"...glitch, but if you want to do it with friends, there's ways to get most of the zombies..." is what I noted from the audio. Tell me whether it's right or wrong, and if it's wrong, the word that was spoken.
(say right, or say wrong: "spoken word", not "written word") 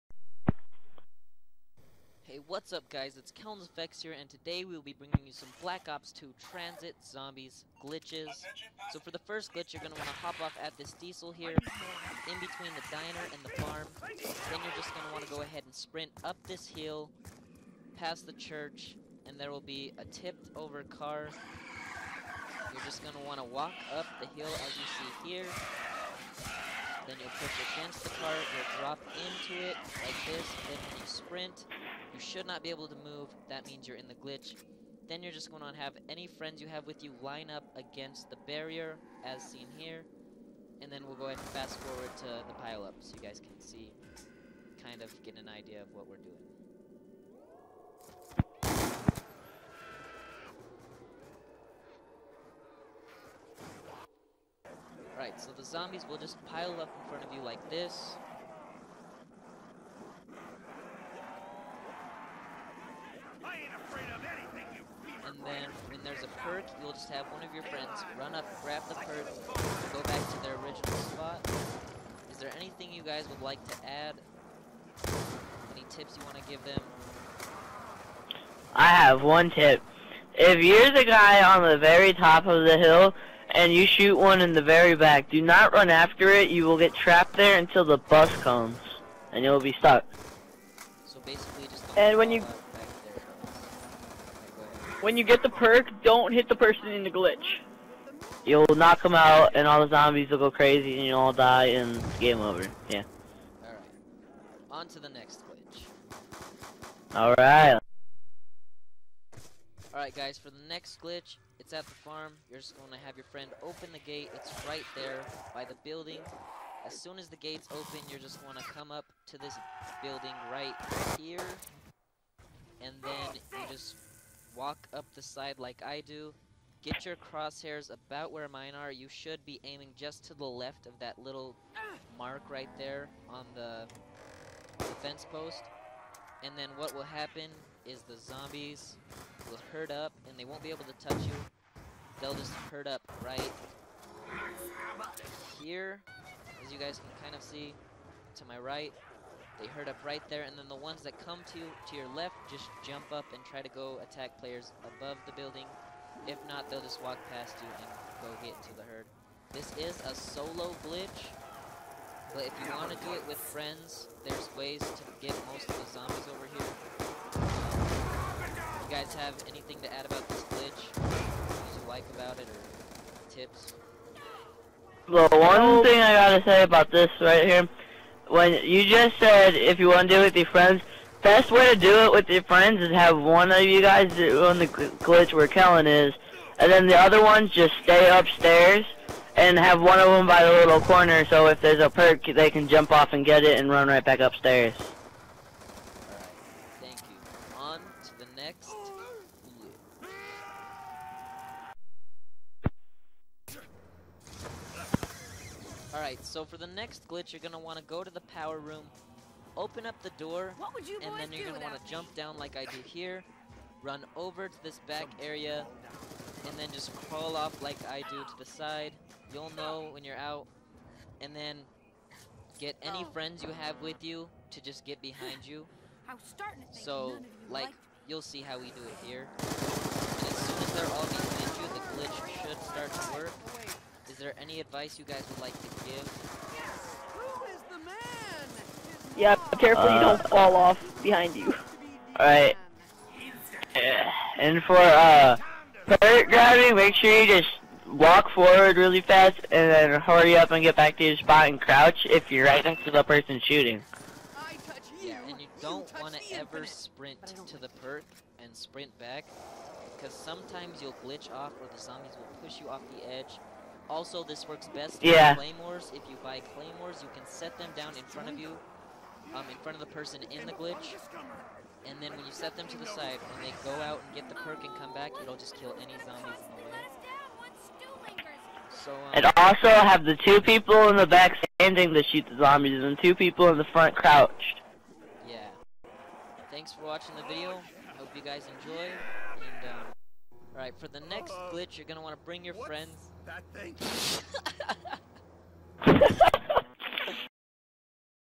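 right.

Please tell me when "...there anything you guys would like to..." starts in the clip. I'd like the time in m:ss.
1:12.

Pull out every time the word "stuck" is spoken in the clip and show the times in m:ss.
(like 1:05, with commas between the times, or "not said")
1:29.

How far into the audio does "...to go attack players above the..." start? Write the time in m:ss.
2:33.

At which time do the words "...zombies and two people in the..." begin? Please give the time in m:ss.
4:42.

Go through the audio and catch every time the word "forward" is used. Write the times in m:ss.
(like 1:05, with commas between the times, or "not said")
0:41, 4:08.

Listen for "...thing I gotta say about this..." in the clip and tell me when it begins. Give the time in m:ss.
2:55.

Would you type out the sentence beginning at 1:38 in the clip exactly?
You'll knock them out, and all the zombies will go crazy, and you'll all die, and it's game over.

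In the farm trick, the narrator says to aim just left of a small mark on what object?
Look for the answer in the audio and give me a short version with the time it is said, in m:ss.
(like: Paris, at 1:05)
the fence post, at 2:13.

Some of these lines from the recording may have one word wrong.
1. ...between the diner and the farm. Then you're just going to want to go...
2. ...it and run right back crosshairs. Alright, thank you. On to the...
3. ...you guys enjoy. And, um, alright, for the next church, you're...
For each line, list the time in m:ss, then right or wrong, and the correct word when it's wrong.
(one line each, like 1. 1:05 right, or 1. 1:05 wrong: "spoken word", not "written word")
1. 0:12 right
2. 3:13 wrong: "upstairs", not "crosshairs"
3. 4:48 wrong: "glitch", not "church".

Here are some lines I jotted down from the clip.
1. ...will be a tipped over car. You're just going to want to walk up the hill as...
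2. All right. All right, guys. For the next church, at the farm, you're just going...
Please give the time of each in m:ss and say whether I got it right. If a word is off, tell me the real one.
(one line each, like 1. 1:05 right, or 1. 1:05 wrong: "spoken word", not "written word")
1. 0:19 right
2. 1:47 wrong: "glitch", not "church".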